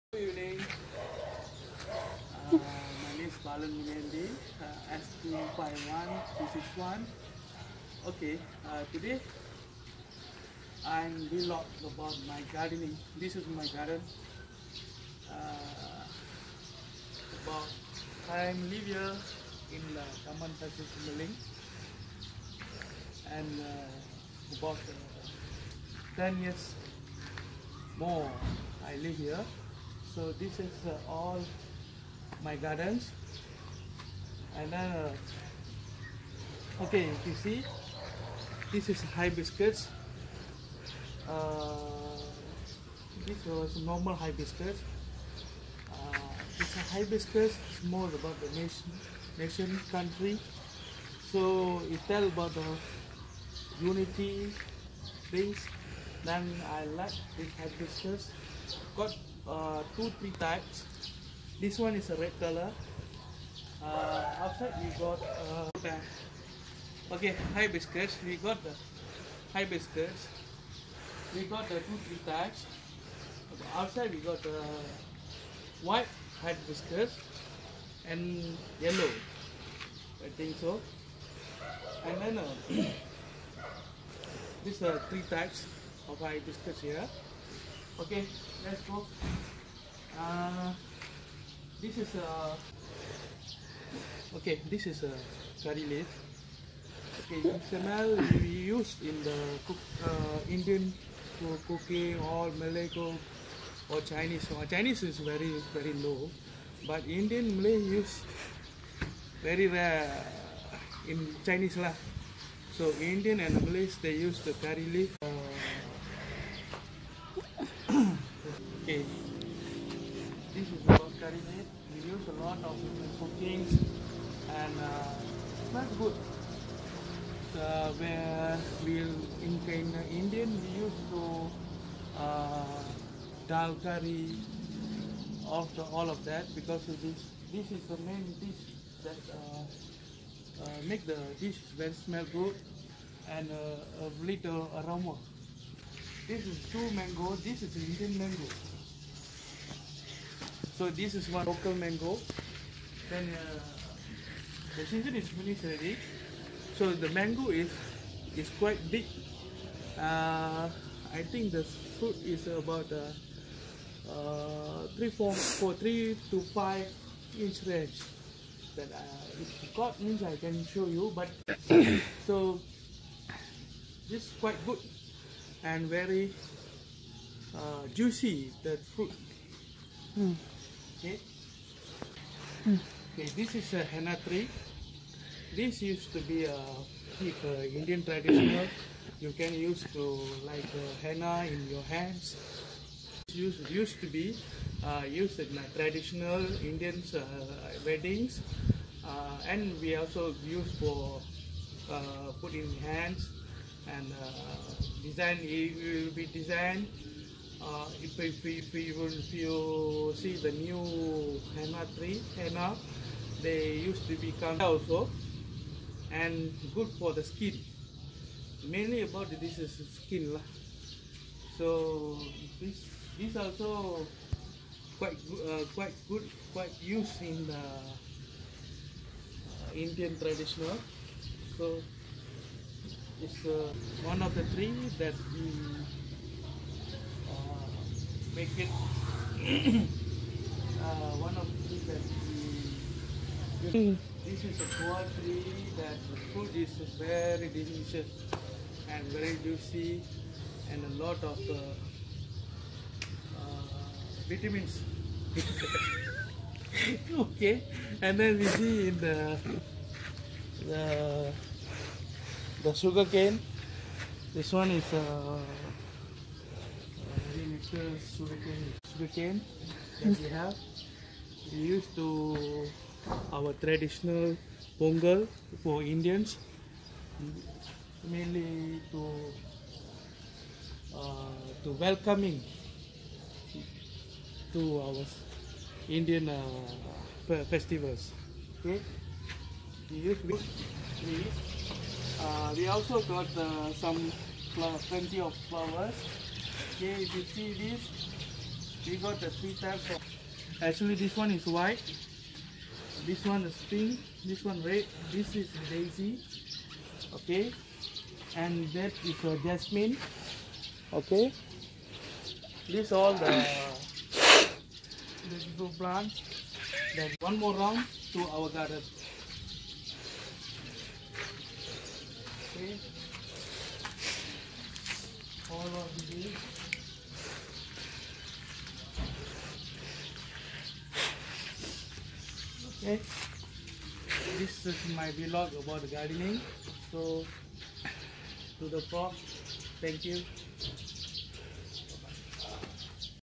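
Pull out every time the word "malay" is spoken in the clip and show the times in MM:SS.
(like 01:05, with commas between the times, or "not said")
01:42, 01:47, 01:53.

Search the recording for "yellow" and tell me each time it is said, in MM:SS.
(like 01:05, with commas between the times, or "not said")
01:18.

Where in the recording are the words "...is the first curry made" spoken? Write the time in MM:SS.
02:00.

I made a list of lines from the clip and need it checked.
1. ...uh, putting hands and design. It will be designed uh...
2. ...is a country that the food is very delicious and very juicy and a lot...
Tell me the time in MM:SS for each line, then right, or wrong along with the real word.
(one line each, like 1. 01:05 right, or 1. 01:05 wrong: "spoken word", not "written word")
1. 03:21 right
2. 04:04 wrong: "poultry", not "country".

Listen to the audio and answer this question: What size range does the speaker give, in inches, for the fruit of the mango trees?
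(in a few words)
3 to 5 inches.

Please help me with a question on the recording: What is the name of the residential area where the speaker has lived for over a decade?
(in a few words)
Taman Pasir Simbaling.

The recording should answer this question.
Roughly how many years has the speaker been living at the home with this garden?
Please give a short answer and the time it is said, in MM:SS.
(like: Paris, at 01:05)
10, at 00:26.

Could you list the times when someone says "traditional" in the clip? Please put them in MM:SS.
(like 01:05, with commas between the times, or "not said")
03:08, 03:15, 03:50, 04:33.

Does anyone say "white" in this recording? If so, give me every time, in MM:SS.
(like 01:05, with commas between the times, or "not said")
01:15, 05:01.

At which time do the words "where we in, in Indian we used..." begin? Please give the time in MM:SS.
02:07.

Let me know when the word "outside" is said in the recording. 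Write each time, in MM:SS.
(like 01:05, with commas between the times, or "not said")
01:04, 01:13.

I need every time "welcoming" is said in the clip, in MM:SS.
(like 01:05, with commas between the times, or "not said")
04:41.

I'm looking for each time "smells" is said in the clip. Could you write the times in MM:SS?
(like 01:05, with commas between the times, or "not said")
02:05, 02:21.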